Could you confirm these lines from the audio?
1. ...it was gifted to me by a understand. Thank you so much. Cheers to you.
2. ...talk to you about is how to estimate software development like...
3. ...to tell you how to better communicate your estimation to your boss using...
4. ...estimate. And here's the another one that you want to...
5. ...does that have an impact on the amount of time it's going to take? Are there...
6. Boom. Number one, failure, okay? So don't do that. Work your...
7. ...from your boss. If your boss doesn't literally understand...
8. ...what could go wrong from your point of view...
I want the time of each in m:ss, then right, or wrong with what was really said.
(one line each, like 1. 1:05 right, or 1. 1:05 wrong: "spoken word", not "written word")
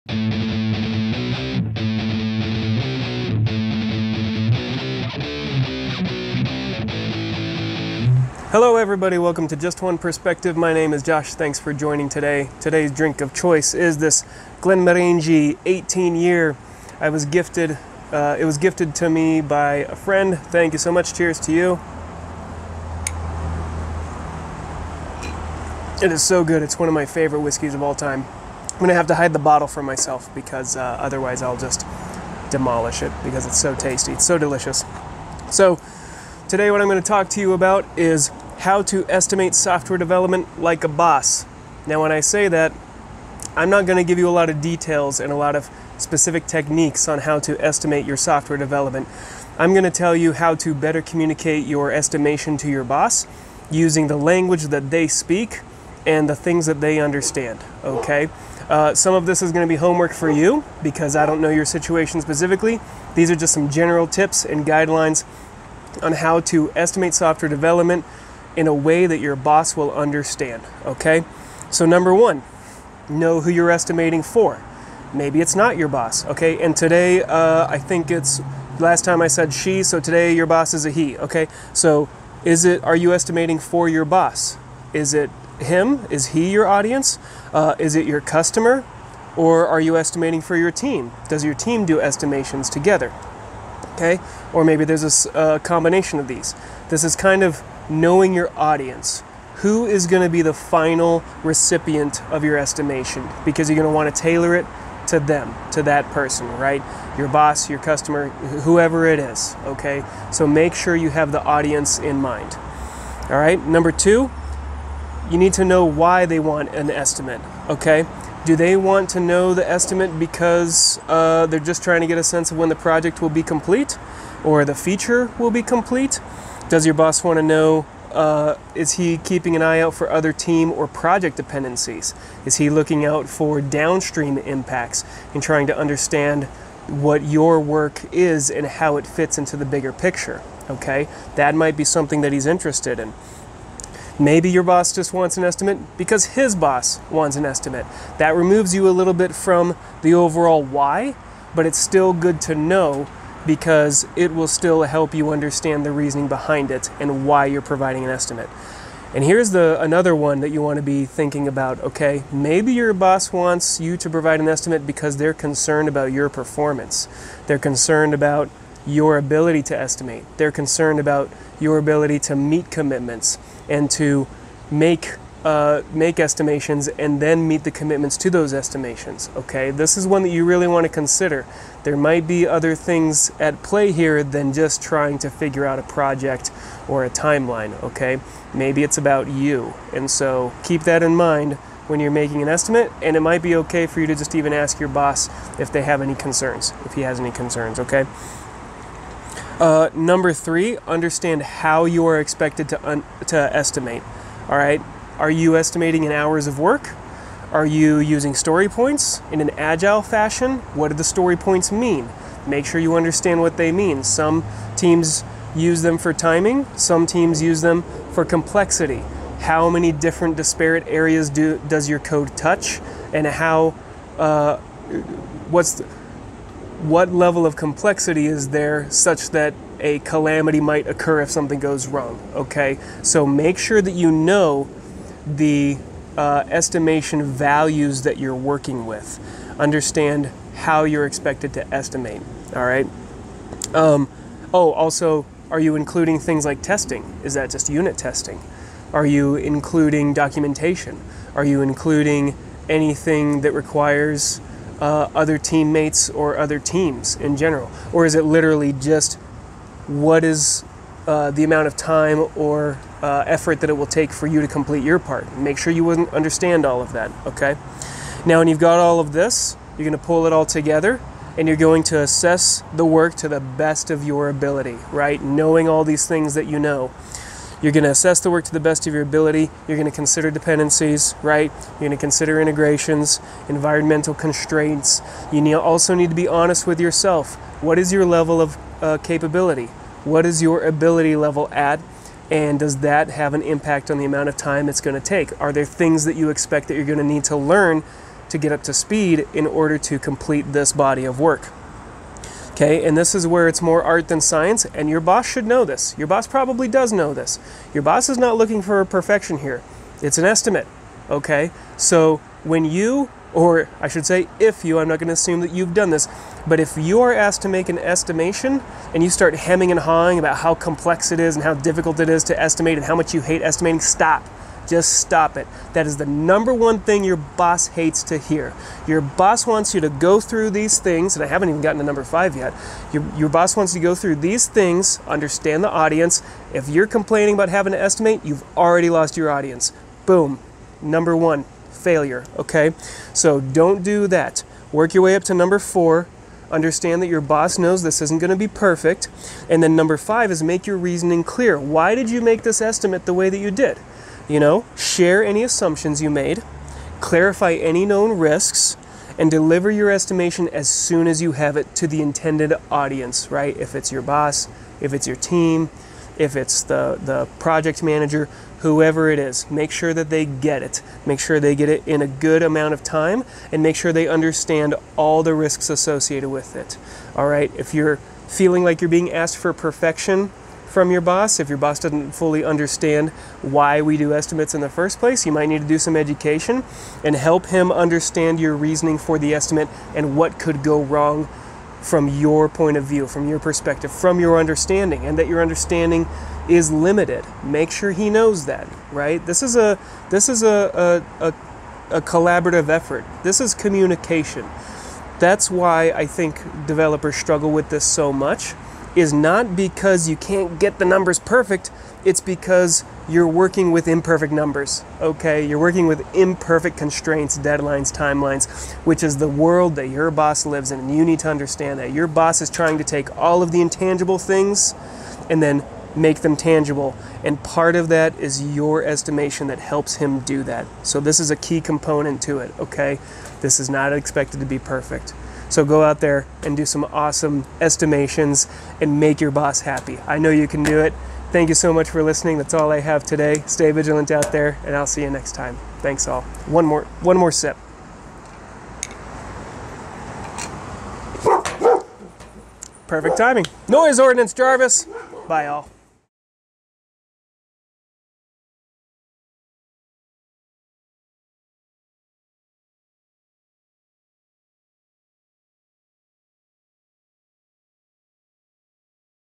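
1. 0:18 wrong: "friend", not "understand"
2. 0:37 right
3. 0:49 right
4. 2:38 right
5. 4:52 right
6. 5:40 right
7. 6:20 wrong: "fully", not "literally"
8. 6:30 right.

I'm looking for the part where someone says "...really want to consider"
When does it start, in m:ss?
3:00.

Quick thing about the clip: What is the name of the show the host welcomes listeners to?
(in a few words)
Just One Perspective.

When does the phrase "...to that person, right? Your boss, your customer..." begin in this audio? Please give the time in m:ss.
1:45.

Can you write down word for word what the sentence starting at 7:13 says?
This is not expected to be perfect.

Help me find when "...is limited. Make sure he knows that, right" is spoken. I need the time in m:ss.
6:36.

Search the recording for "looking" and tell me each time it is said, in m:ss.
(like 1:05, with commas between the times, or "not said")
2:12, 5:08.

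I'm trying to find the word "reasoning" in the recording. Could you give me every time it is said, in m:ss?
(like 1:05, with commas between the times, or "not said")
2:35, 5:50, 6:28.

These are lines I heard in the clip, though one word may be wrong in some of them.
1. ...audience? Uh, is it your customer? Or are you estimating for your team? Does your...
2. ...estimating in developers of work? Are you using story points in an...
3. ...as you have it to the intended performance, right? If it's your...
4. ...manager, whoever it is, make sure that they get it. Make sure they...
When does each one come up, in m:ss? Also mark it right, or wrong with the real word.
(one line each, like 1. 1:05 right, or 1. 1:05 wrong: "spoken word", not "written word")
1. 1:26 right
2. 3:25 wrong: "hours", not "developers"
3. 6:01 wrong: "audience", not "performance"
4. 6:07 right.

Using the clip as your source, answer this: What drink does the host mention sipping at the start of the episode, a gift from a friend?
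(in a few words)
Glenmorangie 18 year.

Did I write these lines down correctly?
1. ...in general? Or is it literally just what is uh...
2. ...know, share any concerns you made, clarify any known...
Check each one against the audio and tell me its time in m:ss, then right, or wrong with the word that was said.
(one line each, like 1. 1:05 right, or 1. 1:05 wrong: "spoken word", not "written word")
1. 4:17 right
2. 5:54 wrong: "assumptions", not "concerns".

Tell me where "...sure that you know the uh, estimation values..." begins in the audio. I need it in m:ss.
3:53.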